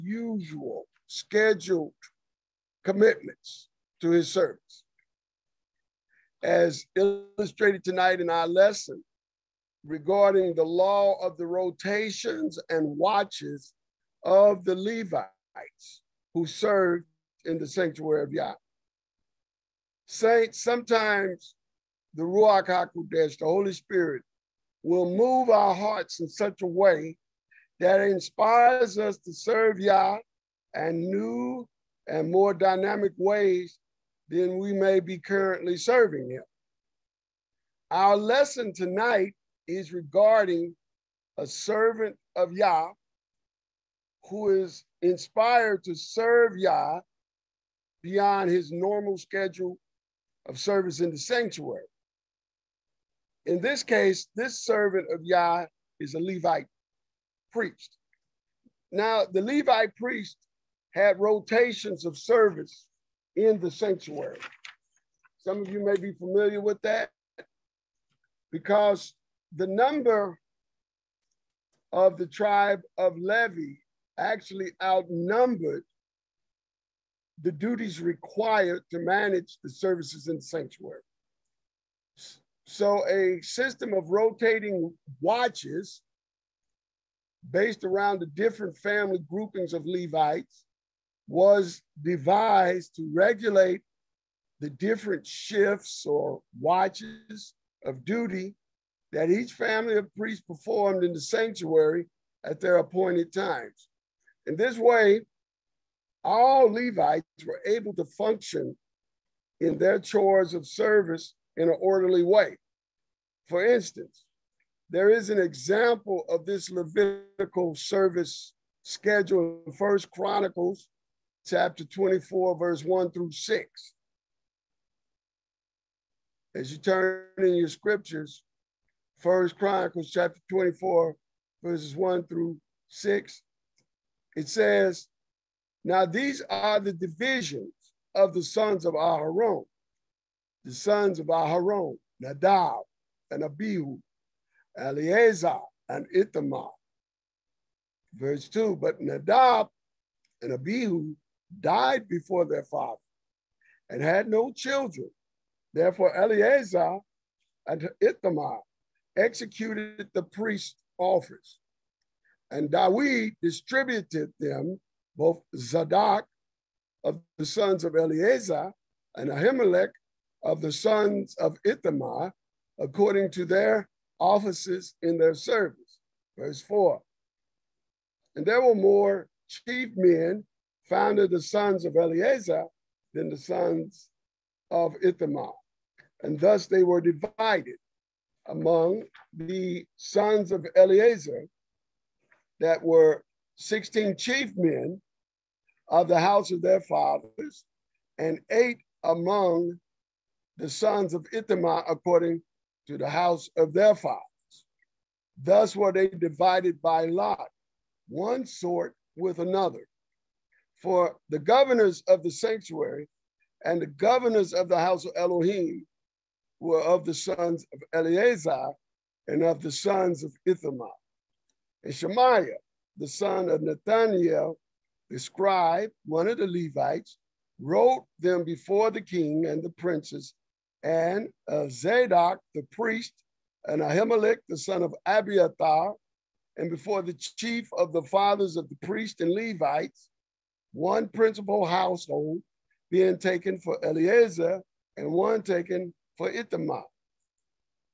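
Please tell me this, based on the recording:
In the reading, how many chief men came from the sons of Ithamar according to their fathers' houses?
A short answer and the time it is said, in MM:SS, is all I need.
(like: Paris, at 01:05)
8, at 03:18.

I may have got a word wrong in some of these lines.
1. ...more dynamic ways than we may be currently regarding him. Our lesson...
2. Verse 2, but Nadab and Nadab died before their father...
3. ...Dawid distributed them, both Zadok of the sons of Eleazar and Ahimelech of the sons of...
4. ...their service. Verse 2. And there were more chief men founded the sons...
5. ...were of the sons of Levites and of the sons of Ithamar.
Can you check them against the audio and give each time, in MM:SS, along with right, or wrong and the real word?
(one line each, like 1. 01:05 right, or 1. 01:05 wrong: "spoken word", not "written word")
1. 00:32 wrong: "serving", not "regarding"
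2. 02:28 wrong: "Abihu", not "Nadab"
3. 02:42 right
4. 02:55 wrong: "4", not "2"
5. 03:36 wrong: "Eleazar", not "Levites".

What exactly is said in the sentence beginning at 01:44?
In this way, all Levites were able to function in their chores of service in an orderly way.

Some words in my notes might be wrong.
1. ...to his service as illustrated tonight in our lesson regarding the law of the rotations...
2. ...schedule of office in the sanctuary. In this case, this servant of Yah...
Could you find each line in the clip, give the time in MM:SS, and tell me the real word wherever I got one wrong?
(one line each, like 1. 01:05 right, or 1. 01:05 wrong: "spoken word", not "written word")
1. 00:03 right
2. 00:49 wrong: "service", not "office".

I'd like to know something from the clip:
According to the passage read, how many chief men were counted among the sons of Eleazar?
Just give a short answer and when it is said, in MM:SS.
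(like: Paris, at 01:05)
16, at 03:13.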